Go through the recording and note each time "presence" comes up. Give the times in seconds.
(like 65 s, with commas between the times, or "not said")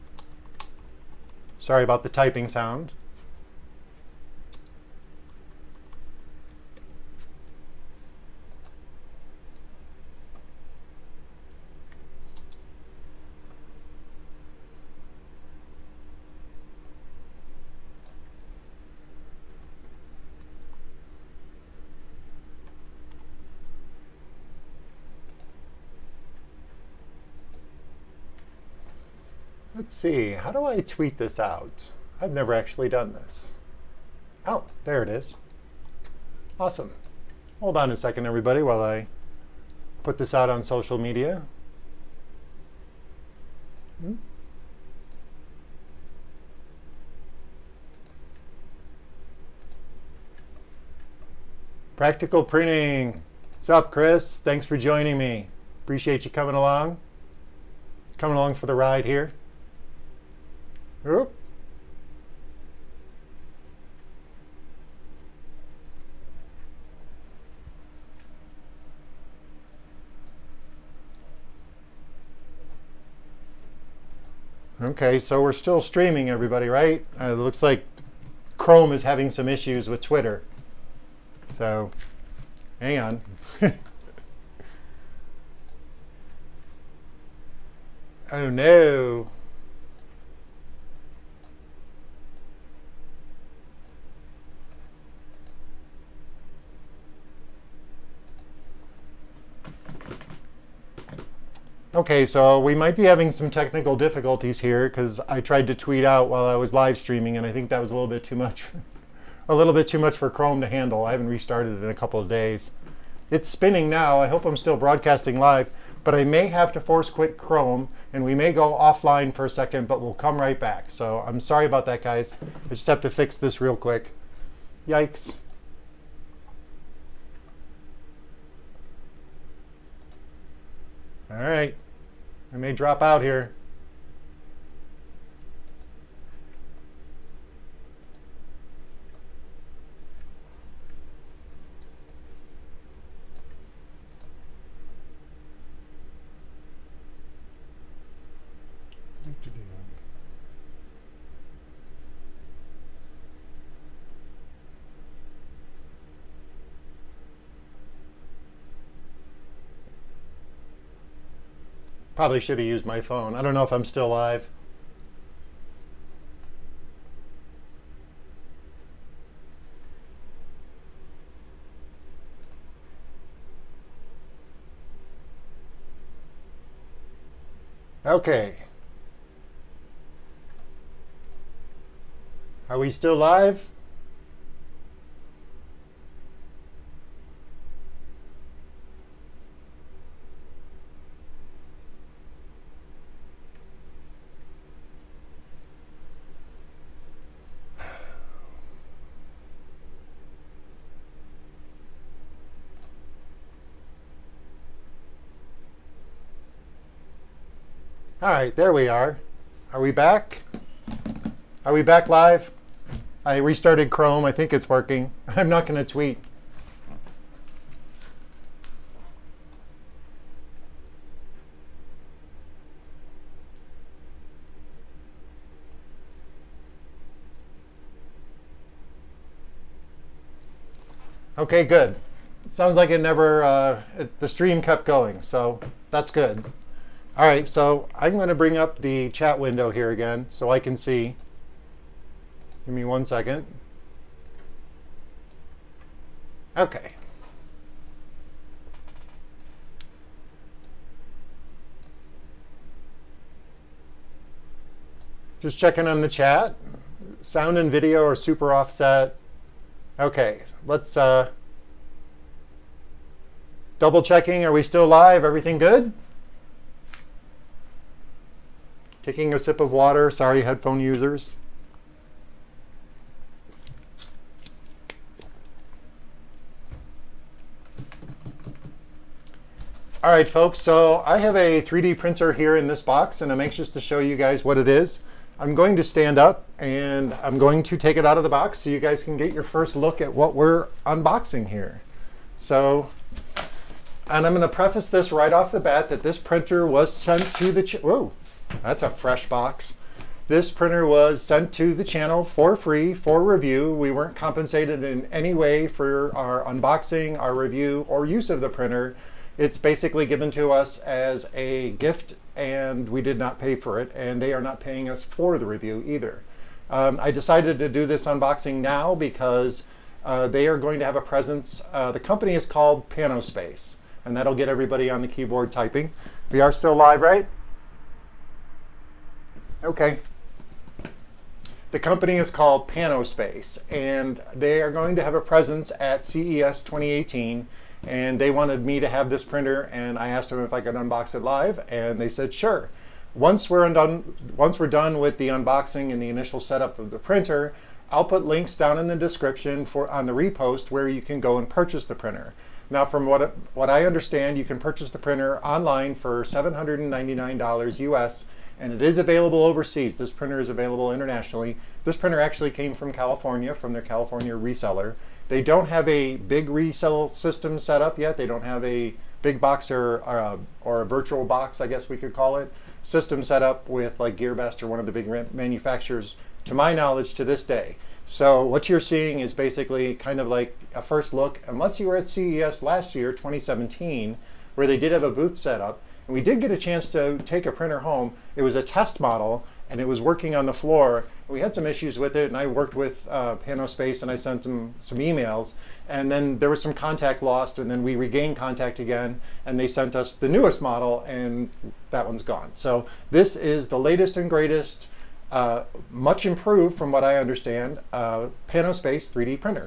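321 s, 335 s.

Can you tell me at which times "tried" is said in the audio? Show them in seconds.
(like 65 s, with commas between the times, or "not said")
105 s.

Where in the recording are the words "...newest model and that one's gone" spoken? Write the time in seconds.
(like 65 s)
400 s.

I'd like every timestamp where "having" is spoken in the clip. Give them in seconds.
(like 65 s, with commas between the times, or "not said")
79 s, 103 s.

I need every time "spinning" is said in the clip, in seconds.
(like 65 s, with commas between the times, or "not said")
113 s.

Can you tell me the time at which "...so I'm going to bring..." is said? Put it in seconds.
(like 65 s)
237 s.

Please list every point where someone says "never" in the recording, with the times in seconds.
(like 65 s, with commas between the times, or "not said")
32 s, 233 s.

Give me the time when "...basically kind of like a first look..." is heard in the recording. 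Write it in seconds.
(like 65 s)
379 s.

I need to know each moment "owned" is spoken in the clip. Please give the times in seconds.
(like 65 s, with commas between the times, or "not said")
not said.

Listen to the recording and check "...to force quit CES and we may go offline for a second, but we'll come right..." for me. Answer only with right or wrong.
wrong.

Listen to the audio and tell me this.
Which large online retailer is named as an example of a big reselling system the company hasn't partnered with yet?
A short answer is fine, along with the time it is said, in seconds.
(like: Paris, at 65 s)
GearBest, at 374 s.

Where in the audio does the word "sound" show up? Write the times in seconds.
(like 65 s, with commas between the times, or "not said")
2 s, 232 s, 257 s.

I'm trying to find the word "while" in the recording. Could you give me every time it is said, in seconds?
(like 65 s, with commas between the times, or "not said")
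38 s, 106 s.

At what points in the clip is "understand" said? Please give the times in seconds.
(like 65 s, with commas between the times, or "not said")
353 s, 407 s.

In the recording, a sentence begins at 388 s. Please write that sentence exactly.
It was a test model and it was working on the floor.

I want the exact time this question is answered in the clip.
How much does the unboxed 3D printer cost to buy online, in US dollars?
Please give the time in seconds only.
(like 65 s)
356 s.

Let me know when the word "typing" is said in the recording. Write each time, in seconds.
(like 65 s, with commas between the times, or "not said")
2 s, 325 s.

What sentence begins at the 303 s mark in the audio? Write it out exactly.
We weren't compensated in any way for our unboxing, our review, or use of the printer.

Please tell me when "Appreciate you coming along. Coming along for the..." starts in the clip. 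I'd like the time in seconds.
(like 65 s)
55 s.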